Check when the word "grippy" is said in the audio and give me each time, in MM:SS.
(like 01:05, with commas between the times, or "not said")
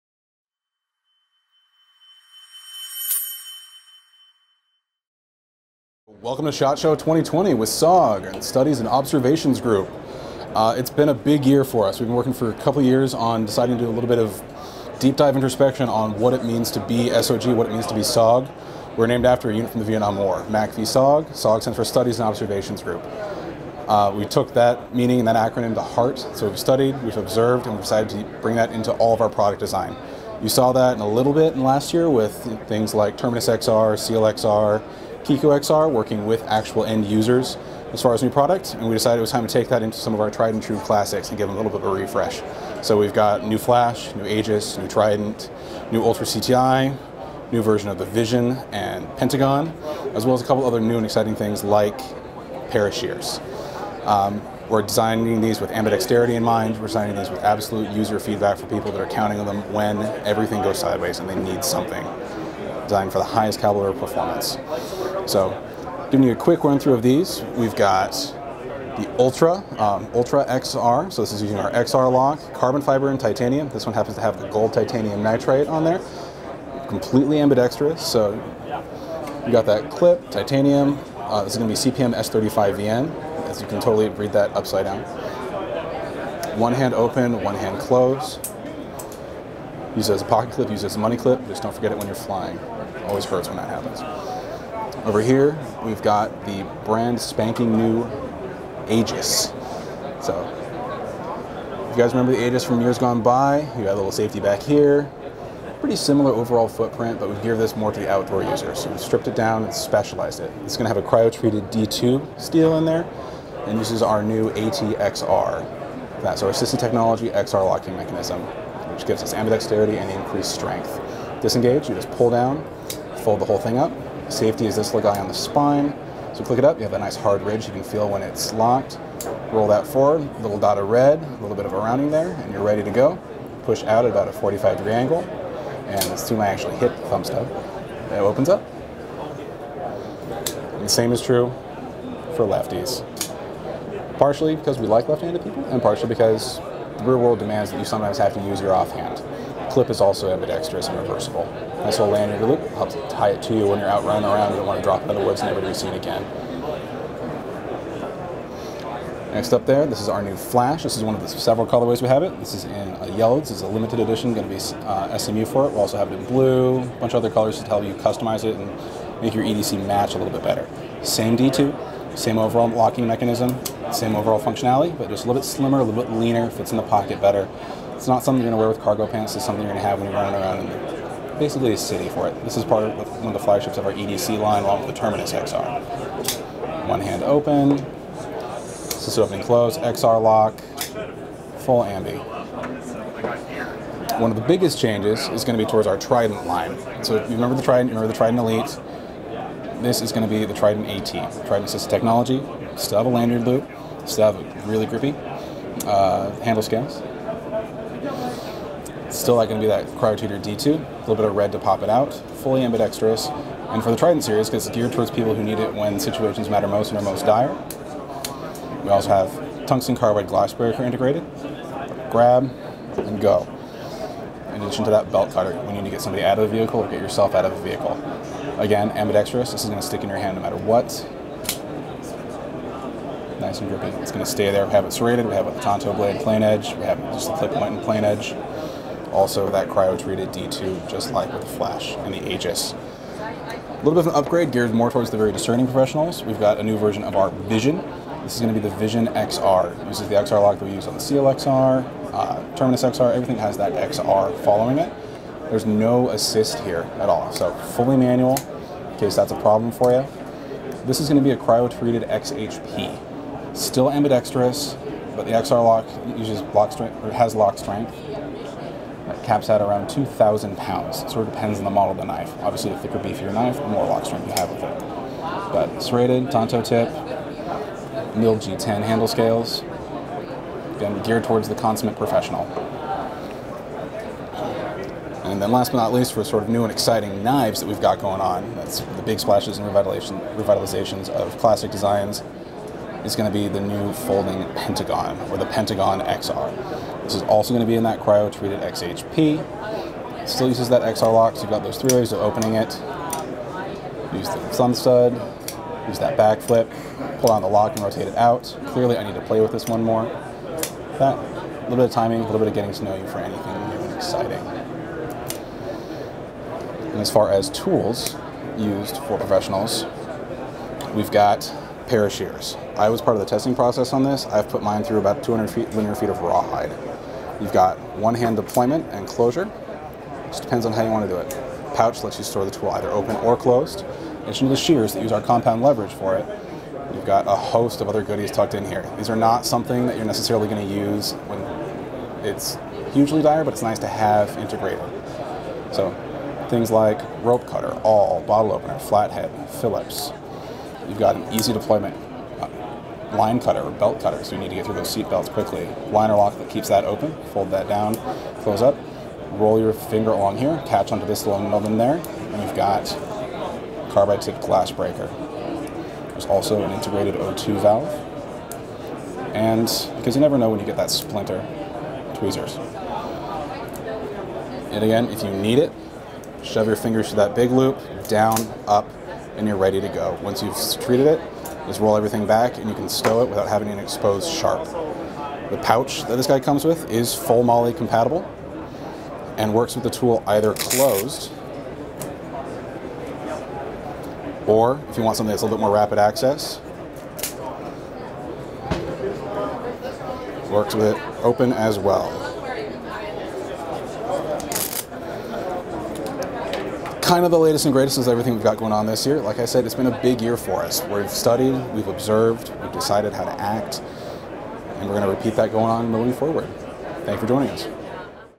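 03:24, 03:53.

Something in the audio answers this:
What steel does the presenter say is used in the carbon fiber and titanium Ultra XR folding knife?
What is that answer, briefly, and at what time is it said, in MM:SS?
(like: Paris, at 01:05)
CPM S35VN, at 01:21.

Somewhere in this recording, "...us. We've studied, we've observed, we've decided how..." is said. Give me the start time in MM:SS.
06:50.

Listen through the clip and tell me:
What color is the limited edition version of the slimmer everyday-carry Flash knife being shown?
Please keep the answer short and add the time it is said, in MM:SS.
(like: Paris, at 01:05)
yellow, at 02:43.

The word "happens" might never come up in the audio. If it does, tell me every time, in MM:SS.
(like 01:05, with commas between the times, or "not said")
01:13, 01:33.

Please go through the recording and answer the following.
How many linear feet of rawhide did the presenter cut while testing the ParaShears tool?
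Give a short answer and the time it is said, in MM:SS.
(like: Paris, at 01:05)
200, at 05:25.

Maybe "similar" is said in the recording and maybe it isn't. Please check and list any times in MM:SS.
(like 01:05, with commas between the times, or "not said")
01:45.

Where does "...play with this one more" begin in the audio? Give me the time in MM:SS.
05:09.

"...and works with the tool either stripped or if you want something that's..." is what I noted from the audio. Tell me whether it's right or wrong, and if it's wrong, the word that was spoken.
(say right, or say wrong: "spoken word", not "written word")
wrong: "closed", not "stripped".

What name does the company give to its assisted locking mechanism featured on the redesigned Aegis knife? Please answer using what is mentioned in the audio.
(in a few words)
ATXR.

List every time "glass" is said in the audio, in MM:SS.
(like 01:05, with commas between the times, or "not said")
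03:40, 06:04.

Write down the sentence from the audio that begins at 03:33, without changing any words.
And for the Trident series, because it's geared towards people who need it when situations matter most and are most dire.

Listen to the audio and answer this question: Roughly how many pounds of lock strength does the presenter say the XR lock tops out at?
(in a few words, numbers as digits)
2,000.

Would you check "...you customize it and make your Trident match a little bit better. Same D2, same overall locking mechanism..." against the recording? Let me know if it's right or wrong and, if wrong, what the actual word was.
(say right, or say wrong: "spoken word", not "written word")
wrong: "EDC", not "Trident".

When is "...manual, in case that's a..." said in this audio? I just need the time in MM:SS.
04:17.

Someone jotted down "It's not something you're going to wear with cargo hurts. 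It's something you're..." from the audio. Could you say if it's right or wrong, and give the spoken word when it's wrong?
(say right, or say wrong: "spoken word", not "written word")
wrong: "pants", not "hurts".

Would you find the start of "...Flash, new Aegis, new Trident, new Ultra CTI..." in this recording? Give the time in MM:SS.
00:43.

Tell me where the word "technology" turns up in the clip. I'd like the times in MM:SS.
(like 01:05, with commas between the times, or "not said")
01:56, 03:21.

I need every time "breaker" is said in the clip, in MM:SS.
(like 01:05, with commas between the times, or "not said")
03:40, 06:04.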